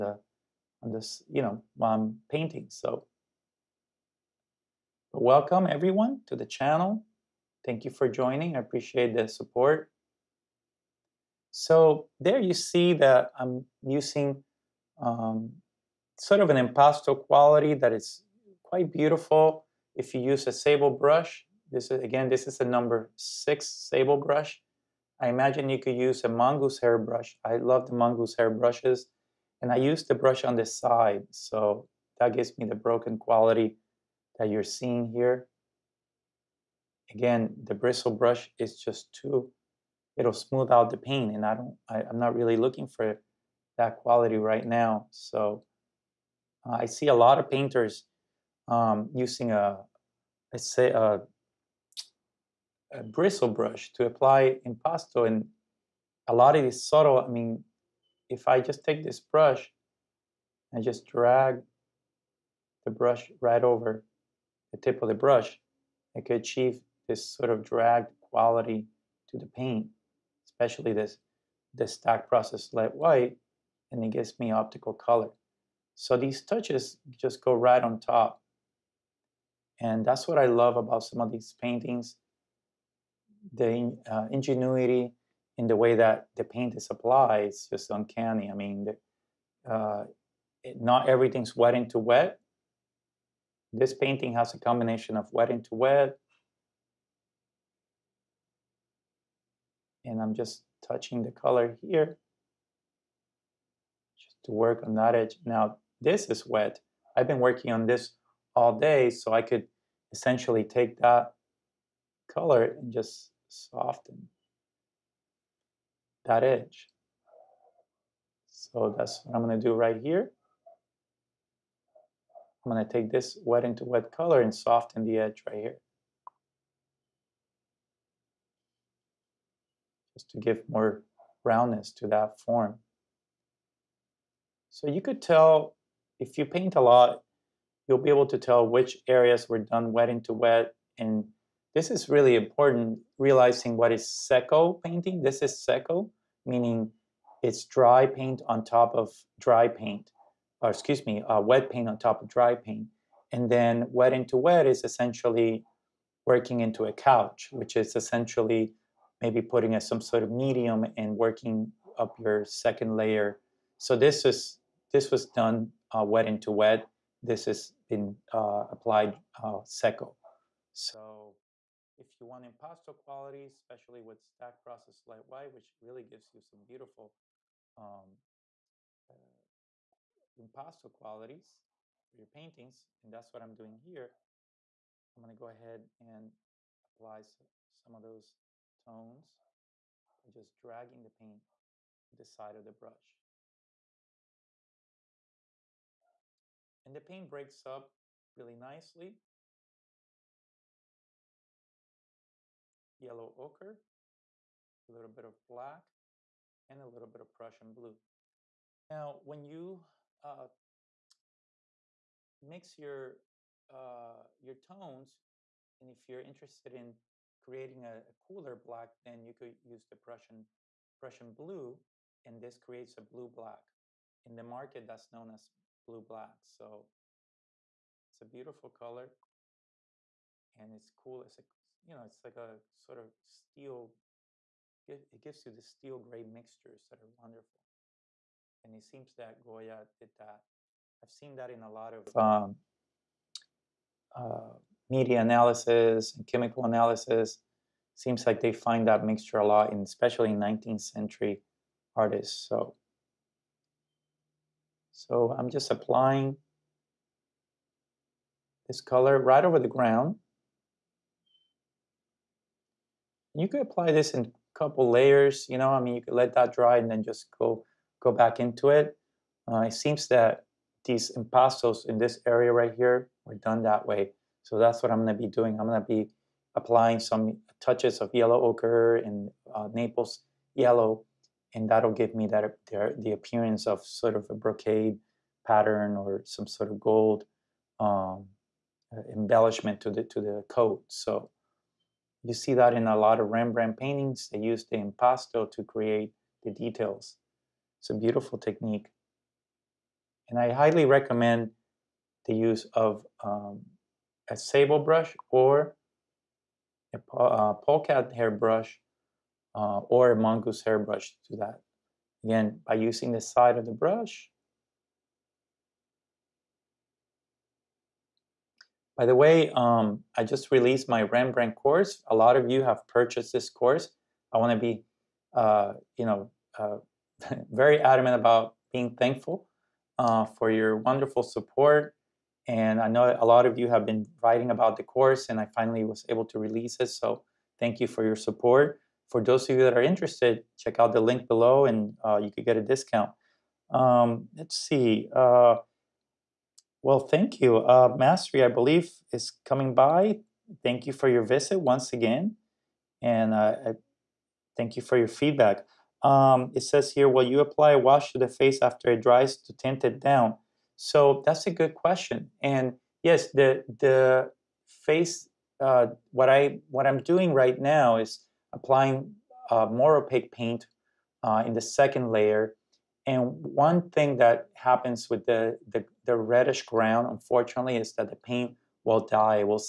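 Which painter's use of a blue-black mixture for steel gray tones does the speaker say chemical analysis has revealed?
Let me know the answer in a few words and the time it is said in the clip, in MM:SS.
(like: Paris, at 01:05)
Goya, at 03:59.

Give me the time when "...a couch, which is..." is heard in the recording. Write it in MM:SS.
02:36.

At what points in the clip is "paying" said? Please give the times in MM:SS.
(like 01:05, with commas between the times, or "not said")
not said.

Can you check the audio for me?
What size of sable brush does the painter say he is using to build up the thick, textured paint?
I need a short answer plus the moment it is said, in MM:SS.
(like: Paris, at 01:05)
6, at 00:22.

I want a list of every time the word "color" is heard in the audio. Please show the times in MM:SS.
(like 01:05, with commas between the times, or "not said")
01:14, 01:41, 01:52, 02:04, 03:48, 04:18.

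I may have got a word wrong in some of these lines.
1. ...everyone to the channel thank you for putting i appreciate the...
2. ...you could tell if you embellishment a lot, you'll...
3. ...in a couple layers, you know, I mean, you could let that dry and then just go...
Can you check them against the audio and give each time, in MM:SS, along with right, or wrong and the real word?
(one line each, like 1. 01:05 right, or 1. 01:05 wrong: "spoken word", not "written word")
1. 00:05 wrong: "joining", not "putting"
2. 02:14 wrong: "paint", not "embellishment"
3. 04:24 right.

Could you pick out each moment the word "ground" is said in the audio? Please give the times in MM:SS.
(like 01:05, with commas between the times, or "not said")
04:19, 06:16.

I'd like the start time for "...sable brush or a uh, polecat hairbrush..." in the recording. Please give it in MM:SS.
05:04.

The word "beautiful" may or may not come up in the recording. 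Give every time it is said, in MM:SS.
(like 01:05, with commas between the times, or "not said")
00:18, 02:56, 03:48, 04:57.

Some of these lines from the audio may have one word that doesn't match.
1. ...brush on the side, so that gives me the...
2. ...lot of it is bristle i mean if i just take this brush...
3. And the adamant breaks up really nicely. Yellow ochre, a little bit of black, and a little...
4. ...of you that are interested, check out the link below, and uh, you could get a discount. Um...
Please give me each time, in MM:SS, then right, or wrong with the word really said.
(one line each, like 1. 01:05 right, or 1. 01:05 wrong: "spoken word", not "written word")
1. 00:30 right
2. 00:56 wrong: "subtle", not "bristle"
3. 03:16 wrong: "paint", not "adamant"
4. 05:39 right.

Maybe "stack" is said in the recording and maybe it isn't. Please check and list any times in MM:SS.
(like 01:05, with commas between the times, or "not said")
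01:11, 02:54.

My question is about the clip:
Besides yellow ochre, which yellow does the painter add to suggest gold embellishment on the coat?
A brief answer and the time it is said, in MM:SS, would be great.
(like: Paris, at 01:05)
Naples yellow, at 04:39.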